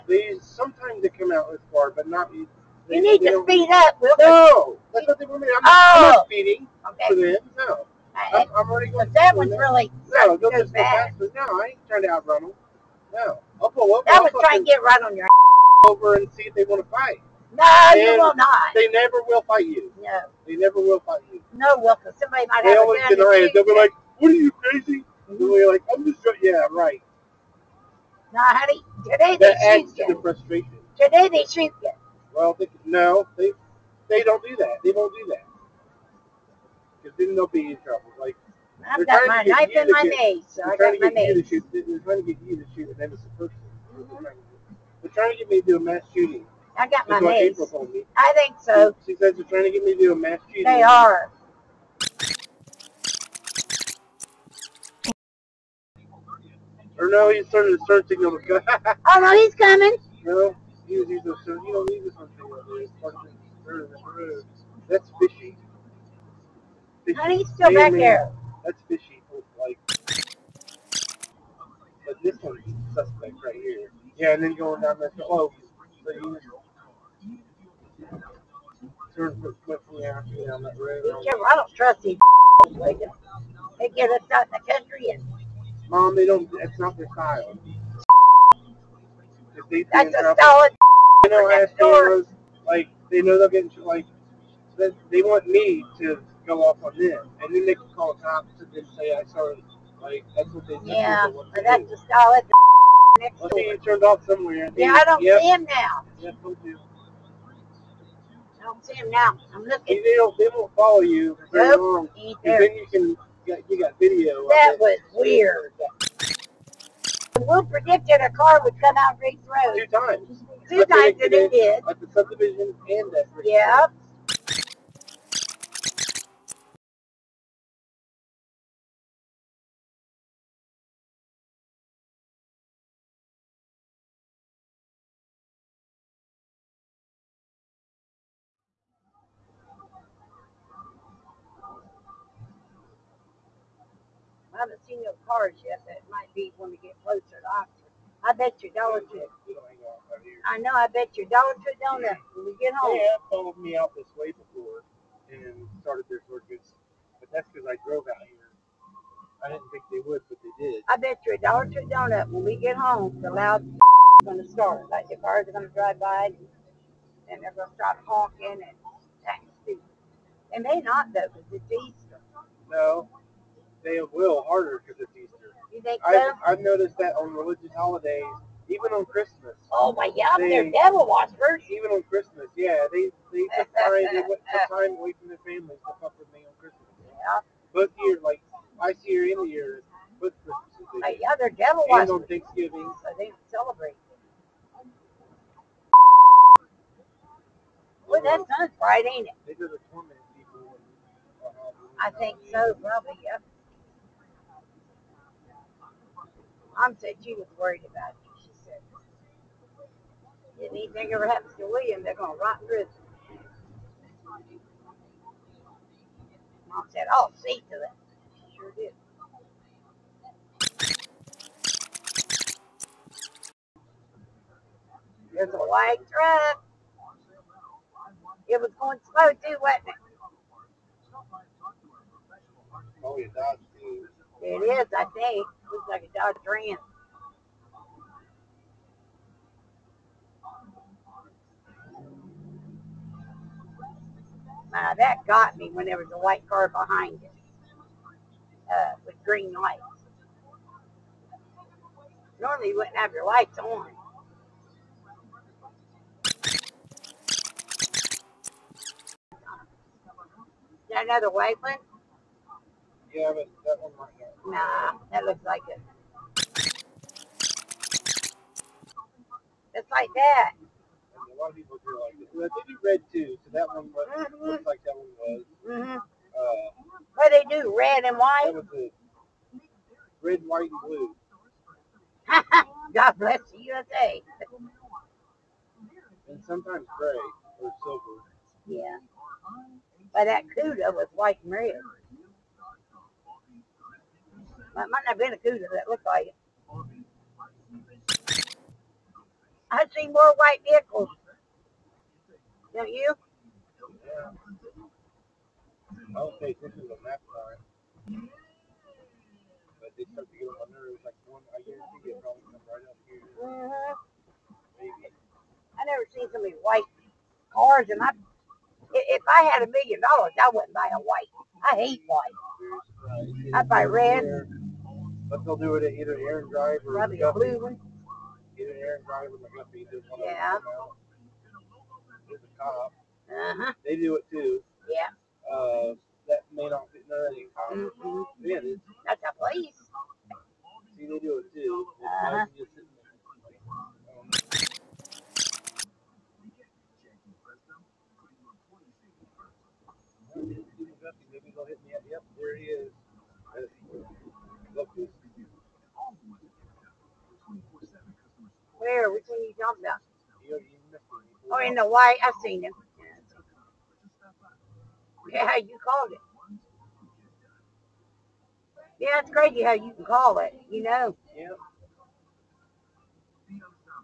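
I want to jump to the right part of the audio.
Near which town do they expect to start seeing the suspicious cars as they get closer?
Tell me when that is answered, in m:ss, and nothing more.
2:27.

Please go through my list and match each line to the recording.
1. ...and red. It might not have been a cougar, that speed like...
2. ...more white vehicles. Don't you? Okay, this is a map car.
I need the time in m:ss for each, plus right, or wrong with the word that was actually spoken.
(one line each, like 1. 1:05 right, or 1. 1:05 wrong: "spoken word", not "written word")
1. 4:51 wrong: "looked", not "speed"
2. 5:00 right.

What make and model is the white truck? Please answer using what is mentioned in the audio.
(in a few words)
Dodge Ram.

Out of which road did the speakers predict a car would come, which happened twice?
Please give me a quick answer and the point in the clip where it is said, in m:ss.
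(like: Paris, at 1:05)
Riggs Road, at 1:59.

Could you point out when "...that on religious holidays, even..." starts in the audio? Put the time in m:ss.
2:56.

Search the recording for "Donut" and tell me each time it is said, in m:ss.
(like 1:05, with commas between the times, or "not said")
2:31, 2:41.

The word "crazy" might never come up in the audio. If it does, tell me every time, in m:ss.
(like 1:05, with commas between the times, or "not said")
0:24, 6:09.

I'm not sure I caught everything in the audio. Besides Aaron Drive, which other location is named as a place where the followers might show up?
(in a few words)
McGuffey.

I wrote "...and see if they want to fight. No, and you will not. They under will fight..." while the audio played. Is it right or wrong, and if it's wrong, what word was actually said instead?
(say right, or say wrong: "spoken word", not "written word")
wrong: "never", not "under".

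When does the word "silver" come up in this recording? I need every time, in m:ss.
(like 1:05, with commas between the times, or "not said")
4:47.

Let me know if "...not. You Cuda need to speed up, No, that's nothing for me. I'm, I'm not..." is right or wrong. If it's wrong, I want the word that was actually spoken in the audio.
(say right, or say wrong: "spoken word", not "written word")
wrong: "You", not "Cuda".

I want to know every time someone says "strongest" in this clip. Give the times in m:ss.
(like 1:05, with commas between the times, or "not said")
not said.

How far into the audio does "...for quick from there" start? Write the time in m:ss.
1:19.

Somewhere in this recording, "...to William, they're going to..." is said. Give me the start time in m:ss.
3:31.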